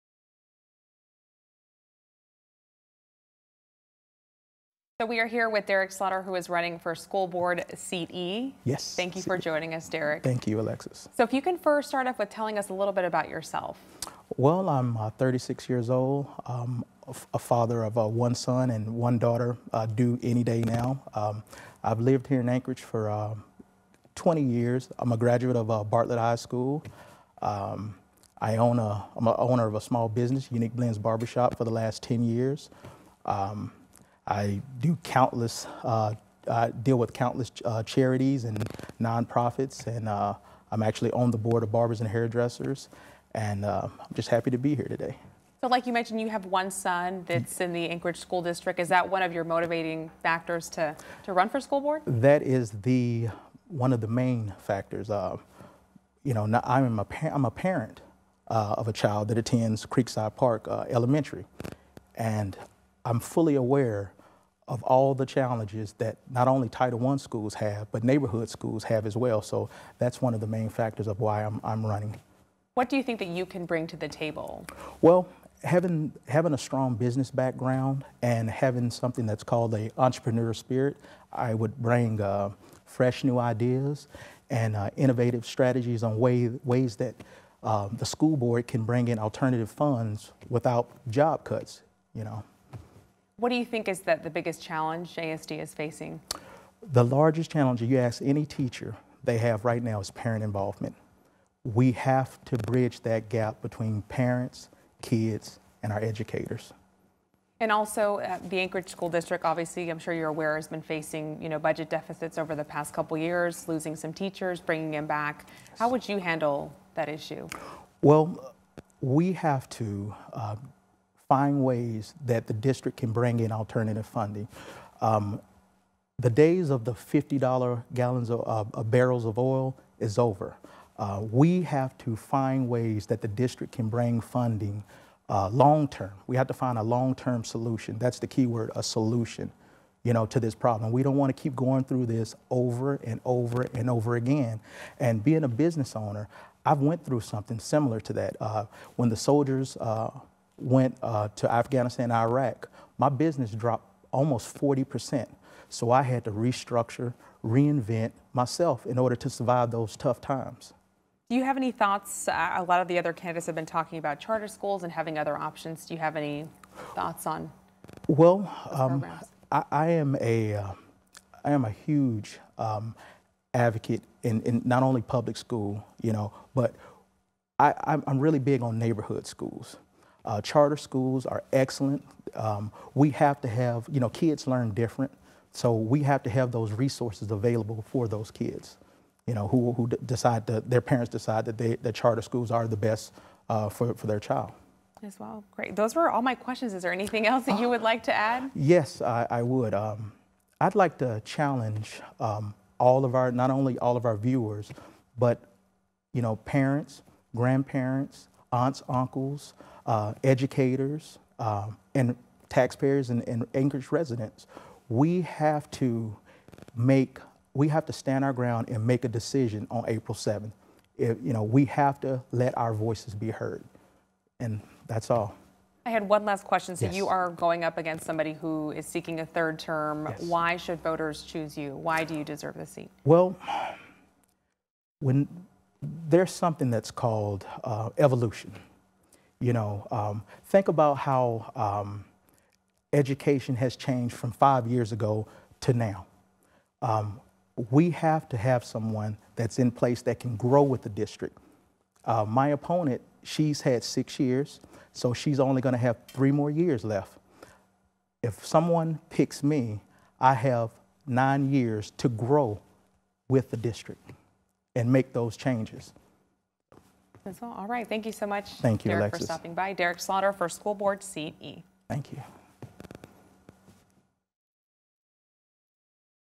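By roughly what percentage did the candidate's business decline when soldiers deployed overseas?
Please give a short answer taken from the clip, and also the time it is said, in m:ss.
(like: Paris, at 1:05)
40%, at 2:34.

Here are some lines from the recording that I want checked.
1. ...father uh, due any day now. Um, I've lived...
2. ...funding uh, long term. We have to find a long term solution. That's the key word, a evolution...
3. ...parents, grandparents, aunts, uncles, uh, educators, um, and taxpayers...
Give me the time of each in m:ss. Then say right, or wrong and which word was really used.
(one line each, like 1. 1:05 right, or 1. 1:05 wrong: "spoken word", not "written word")
1. 0:19 wrong: "daughter", not "father"
2. 2:14 wrong: "solution", not "evolution"
3. 3:26 right.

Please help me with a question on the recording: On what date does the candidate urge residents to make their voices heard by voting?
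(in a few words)
April 7th.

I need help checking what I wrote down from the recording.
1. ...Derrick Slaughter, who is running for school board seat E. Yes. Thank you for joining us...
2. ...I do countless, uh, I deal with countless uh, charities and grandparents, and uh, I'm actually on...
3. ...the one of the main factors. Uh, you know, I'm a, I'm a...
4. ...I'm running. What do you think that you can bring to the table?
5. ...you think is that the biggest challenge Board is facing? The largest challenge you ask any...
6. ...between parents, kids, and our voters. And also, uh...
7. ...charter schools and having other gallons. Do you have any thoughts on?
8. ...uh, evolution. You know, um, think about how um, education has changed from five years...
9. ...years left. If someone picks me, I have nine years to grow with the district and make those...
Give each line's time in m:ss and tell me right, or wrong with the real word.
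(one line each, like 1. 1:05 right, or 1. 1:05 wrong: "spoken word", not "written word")
1. 0:05 right
2. 0:34 wrong: "nonprofits", not "grandparents"
3. 0:52 right
4. 1:11 right
5. 1:33 wrong: "ASD", not "Board"
6. 1:43 wrong: "educators", not "voters"
7. 2:44 wrong: "options", not "gallons"
8. 3:57 right
9. 4:16 right.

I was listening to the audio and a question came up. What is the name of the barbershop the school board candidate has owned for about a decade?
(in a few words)
Unique Blends Barbershop.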